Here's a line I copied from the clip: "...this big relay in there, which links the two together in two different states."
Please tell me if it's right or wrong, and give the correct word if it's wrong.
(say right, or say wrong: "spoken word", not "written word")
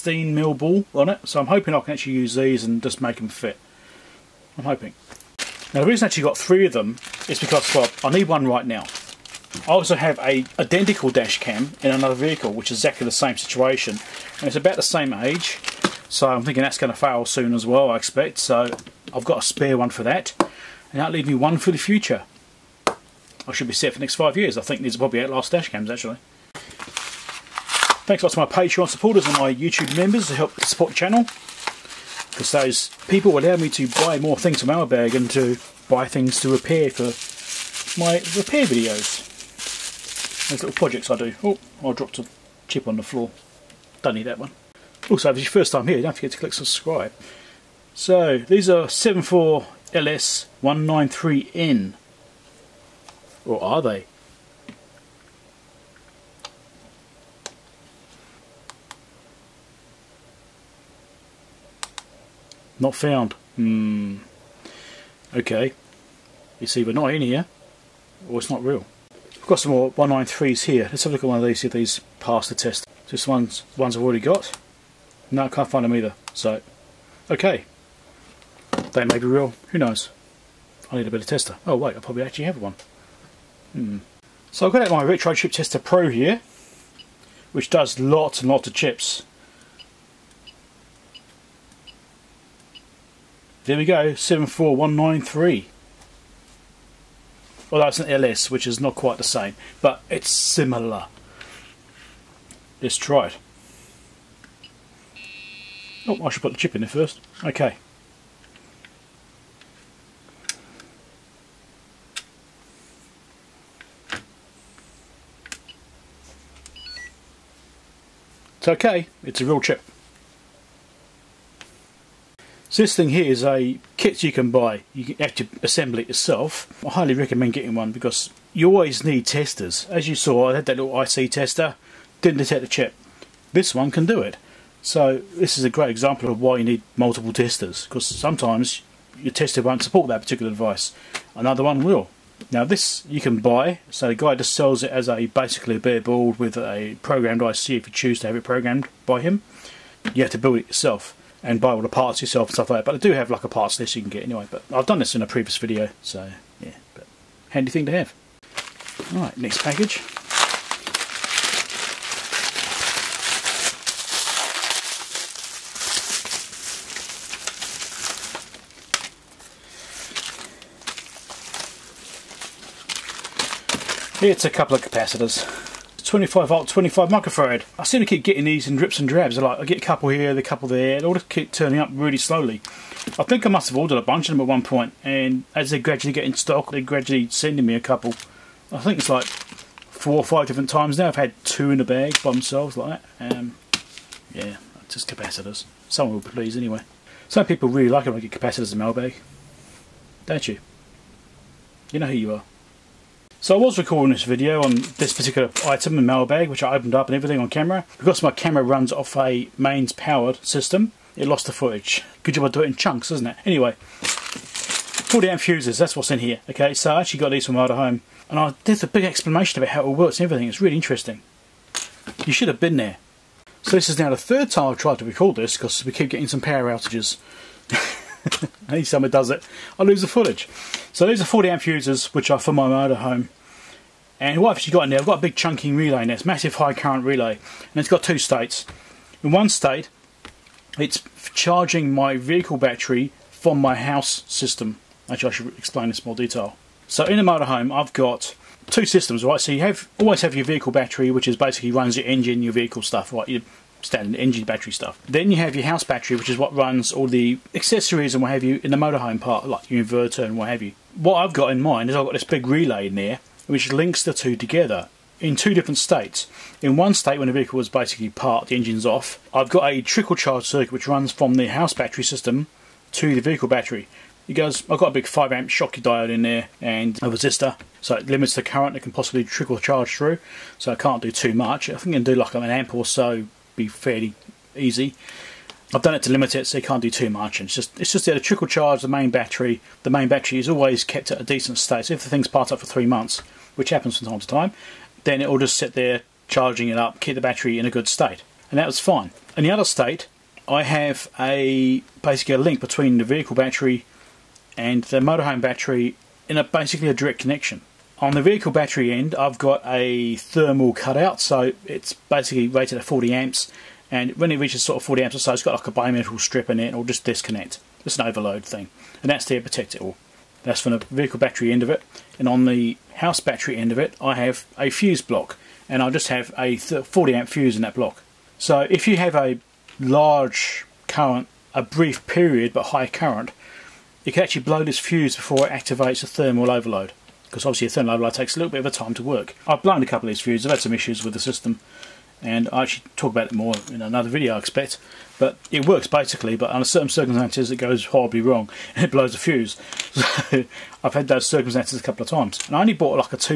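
right.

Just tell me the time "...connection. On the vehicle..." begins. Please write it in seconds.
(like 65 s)
307 s.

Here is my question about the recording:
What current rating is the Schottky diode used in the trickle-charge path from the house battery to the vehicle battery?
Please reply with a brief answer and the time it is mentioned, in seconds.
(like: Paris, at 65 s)
5 amp, at 275 s.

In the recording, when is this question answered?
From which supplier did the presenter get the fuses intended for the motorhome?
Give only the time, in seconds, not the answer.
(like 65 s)
217 s.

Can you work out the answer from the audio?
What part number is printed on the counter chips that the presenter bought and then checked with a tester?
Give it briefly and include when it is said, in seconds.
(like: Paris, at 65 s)
74LS193N, at 48 s.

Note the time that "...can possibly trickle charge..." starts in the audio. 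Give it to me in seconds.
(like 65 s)
278 s.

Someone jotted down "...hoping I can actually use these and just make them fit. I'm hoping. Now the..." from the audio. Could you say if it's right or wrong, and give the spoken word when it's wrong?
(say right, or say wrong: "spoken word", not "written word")
right.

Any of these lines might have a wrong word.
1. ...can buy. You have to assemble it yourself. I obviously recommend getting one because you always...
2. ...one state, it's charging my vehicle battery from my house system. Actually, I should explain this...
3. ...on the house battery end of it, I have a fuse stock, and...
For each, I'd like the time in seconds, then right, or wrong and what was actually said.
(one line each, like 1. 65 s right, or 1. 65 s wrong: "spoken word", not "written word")
1. 124 s wrong: "highly", not "obviously"
2. 239 s right
3. 322 s wrong: "block", not "stock".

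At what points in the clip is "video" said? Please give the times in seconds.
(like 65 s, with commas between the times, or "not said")
38 s, 155 s, 204 s, 344 s.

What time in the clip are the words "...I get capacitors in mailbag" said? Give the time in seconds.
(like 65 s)
198 s.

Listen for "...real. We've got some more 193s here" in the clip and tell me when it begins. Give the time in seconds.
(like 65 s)
68 s.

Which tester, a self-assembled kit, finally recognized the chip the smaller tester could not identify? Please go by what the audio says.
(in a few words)
Retro Chip Tester Pro.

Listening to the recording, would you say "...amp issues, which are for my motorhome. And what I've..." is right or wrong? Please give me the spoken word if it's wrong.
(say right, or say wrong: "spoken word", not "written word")
wrong: "fuses", not "issues".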